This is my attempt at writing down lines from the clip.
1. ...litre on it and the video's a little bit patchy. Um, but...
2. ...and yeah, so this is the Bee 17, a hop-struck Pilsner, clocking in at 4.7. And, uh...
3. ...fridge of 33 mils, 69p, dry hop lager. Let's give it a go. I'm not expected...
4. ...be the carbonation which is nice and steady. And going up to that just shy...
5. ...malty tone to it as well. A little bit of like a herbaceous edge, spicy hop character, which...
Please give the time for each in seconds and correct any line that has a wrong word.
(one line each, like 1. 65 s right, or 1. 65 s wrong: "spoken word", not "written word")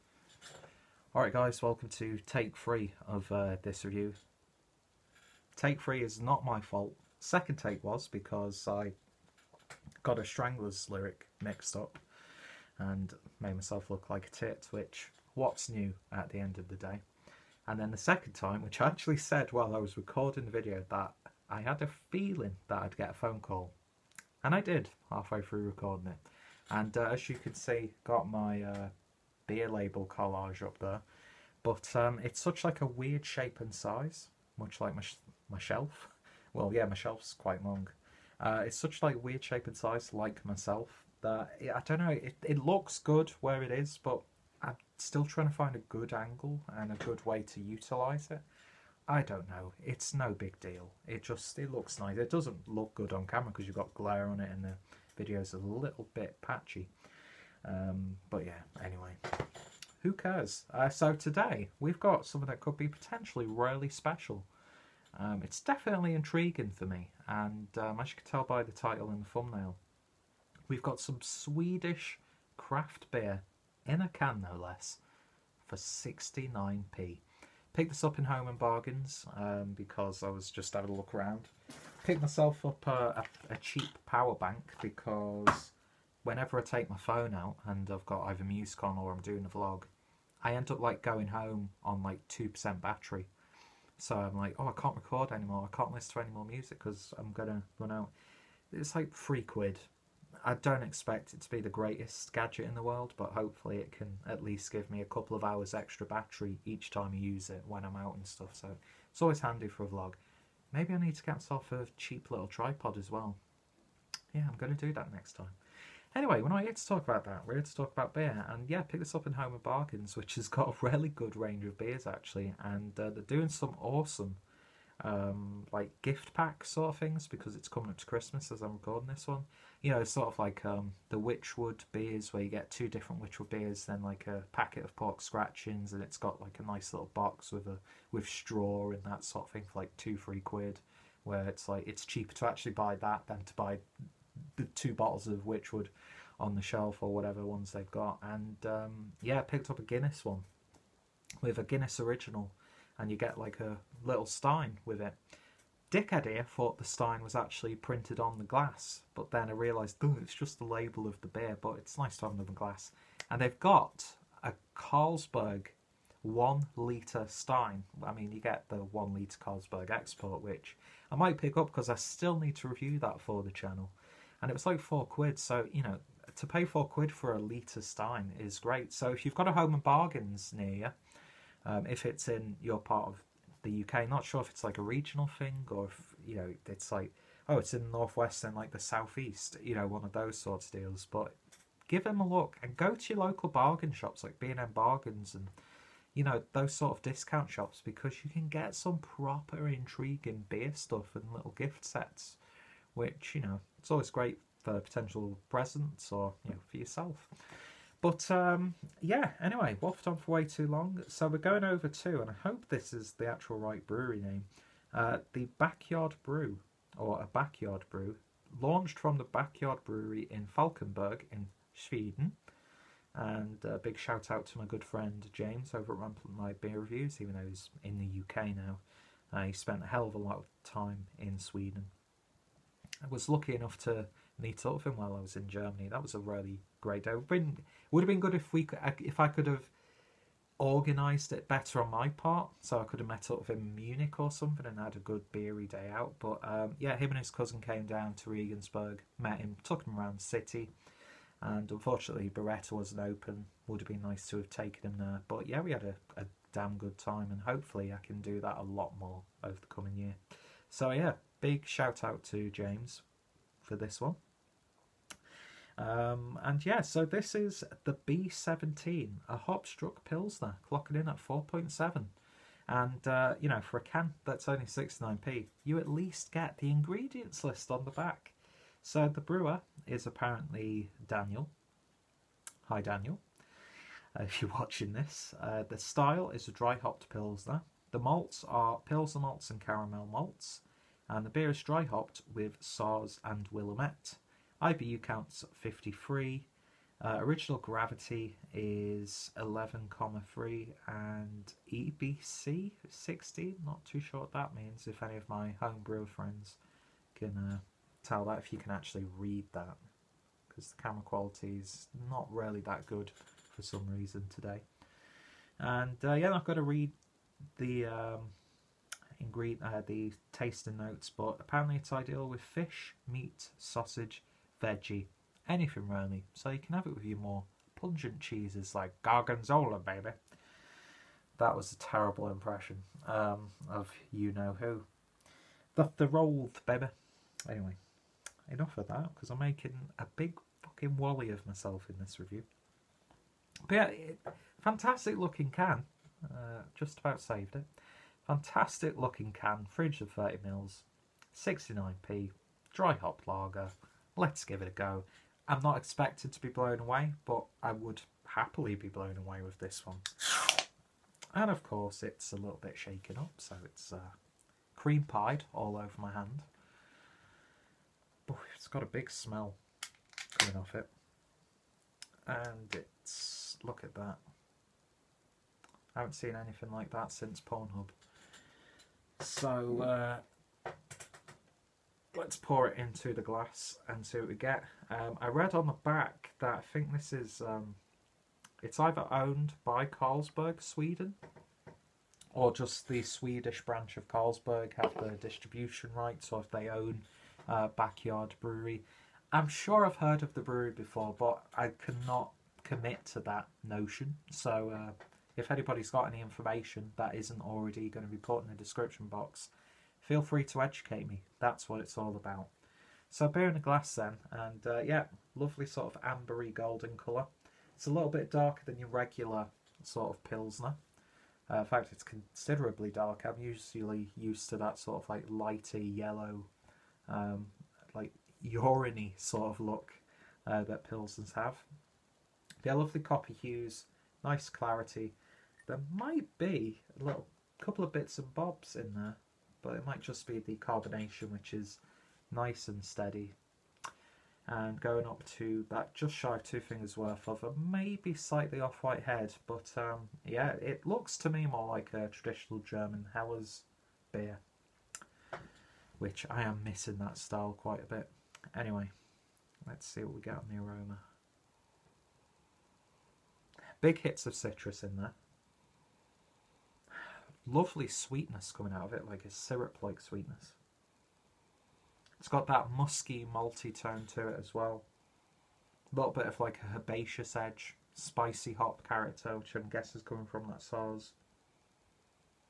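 1. 53 s wrong: "glare", not "litre"
2. 266 s right
3. 349 s wrong: "30", not "33"
4. 440 s right
5. 473 s right.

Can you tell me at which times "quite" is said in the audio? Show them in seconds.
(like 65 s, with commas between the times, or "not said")
37 s, 457 s.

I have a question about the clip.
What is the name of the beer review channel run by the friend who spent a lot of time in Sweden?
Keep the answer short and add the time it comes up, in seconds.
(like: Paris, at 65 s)
Rampant Light Beer Reviews, at 226 s.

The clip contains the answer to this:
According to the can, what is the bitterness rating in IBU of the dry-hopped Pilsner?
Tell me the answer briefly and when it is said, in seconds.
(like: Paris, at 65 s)
53, at 295 s.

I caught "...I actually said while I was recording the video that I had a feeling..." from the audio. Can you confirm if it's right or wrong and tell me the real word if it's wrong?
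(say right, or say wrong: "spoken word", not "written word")
right.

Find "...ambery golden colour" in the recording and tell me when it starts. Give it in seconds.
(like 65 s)
416 s.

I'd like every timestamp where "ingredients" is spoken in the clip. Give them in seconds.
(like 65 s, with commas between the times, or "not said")
276 s, 319 s.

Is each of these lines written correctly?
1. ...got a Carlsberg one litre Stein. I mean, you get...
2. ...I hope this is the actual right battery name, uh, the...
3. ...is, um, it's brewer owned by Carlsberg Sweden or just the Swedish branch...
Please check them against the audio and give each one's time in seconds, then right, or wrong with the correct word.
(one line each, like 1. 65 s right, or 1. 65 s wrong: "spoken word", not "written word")
1. 163 s right
2. 212 s wrong: "brewery", not "battery"
3. 387 s wrong: "either", not "brewer".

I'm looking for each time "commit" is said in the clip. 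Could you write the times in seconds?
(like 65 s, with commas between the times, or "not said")
402 s.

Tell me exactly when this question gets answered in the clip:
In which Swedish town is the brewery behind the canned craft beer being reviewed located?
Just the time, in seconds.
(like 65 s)
220 s.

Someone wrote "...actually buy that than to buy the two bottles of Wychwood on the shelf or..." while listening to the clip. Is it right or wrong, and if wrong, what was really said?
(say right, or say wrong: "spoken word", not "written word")
right.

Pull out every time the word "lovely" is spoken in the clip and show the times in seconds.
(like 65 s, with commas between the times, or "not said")
415 s, 432 s, 467 s.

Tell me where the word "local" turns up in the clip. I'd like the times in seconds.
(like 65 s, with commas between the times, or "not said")
193 s.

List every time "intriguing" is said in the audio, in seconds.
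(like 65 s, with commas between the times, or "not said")
66 s, 199 s.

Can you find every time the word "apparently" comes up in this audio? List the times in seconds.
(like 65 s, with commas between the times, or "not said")
280 s, 321 s.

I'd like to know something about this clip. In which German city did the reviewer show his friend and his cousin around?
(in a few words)
Regensburg.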